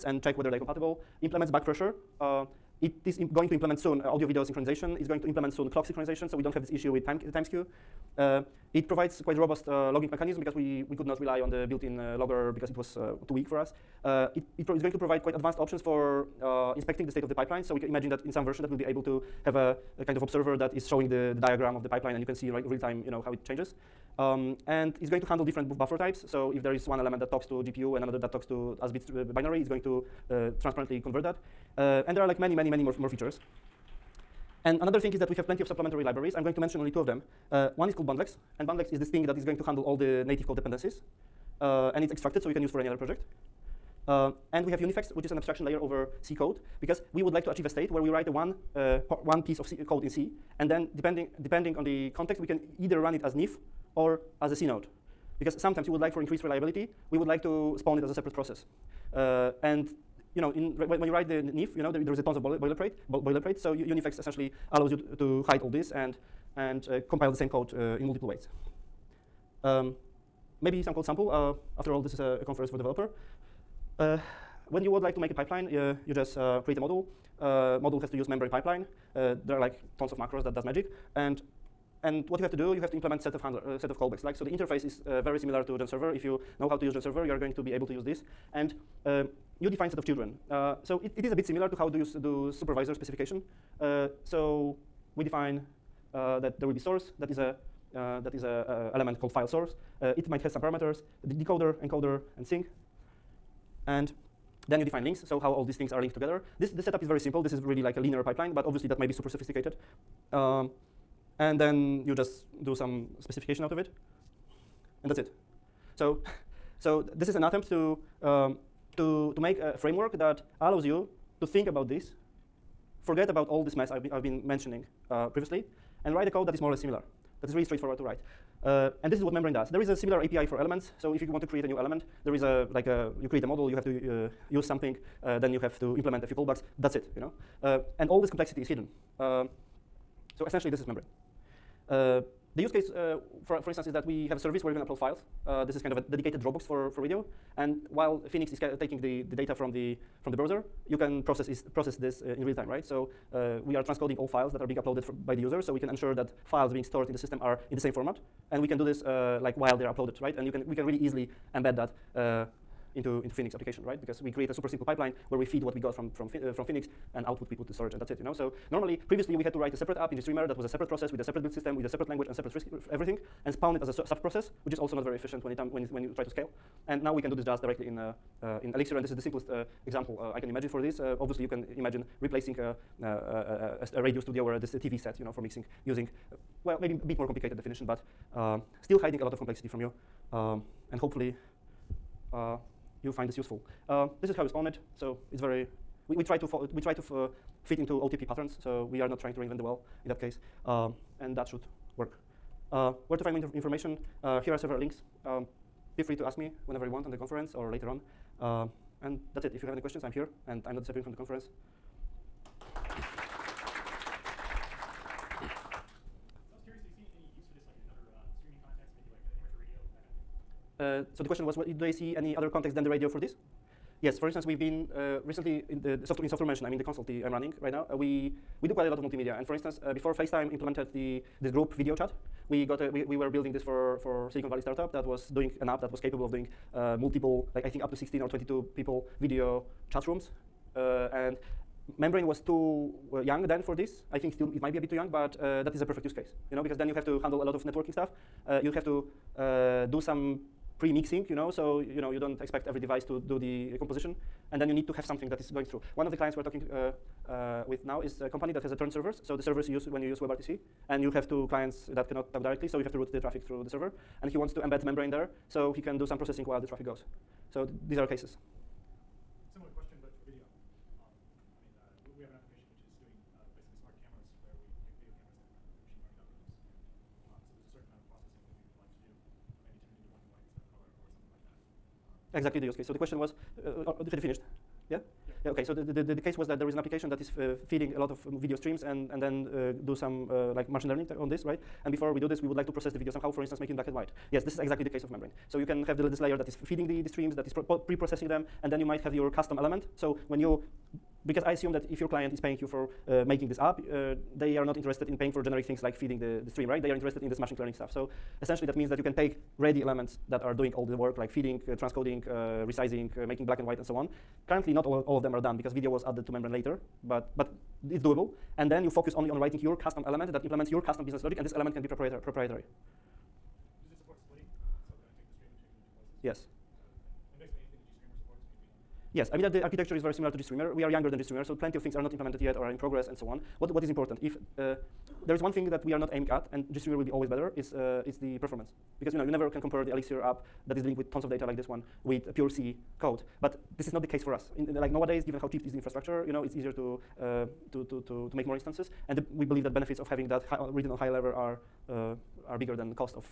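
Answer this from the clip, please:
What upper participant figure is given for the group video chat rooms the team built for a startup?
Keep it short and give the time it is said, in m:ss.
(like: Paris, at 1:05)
22, at 3:58.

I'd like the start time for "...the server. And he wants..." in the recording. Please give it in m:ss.
4:23.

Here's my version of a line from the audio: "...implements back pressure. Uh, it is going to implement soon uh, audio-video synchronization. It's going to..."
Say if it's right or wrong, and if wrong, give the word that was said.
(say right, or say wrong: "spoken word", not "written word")
right.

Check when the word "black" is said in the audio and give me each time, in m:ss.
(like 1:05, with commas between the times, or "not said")
4:53, 5:13.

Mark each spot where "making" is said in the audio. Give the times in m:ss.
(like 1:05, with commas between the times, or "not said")
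4:53, 5:03, 5:13.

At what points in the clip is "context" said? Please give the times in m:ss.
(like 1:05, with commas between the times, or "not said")
0:52, 3:42.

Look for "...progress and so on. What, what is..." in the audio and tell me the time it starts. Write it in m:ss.
5:32.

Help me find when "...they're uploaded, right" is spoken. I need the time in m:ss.
2:39.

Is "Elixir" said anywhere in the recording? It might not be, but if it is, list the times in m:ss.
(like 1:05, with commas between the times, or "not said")
2:58, 5:39.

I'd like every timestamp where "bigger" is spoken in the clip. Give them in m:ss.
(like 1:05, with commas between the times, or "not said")
5:52.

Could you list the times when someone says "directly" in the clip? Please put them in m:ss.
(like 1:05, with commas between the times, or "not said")
2:57, 4:22.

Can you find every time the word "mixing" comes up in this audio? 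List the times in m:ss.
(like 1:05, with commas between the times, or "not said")
3:05, 4:10.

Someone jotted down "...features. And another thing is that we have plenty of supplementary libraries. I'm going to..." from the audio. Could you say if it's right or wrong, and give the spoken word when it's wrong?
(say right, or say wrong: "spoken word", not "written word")
right.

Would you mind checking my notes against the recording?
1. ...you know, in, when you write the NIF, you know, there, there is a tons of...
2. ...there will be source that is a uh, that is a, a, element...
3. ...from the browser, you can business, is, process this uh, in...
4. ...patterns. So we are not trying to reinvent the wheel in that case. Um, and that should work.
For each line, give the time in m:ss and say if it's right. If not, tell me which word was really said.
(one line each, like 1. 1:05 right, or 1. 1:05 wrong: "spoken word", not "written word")
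1. 1:00 right
2. 1:36 right
3. 2:30 wrong: "process", not "business"
4. 3:18 right.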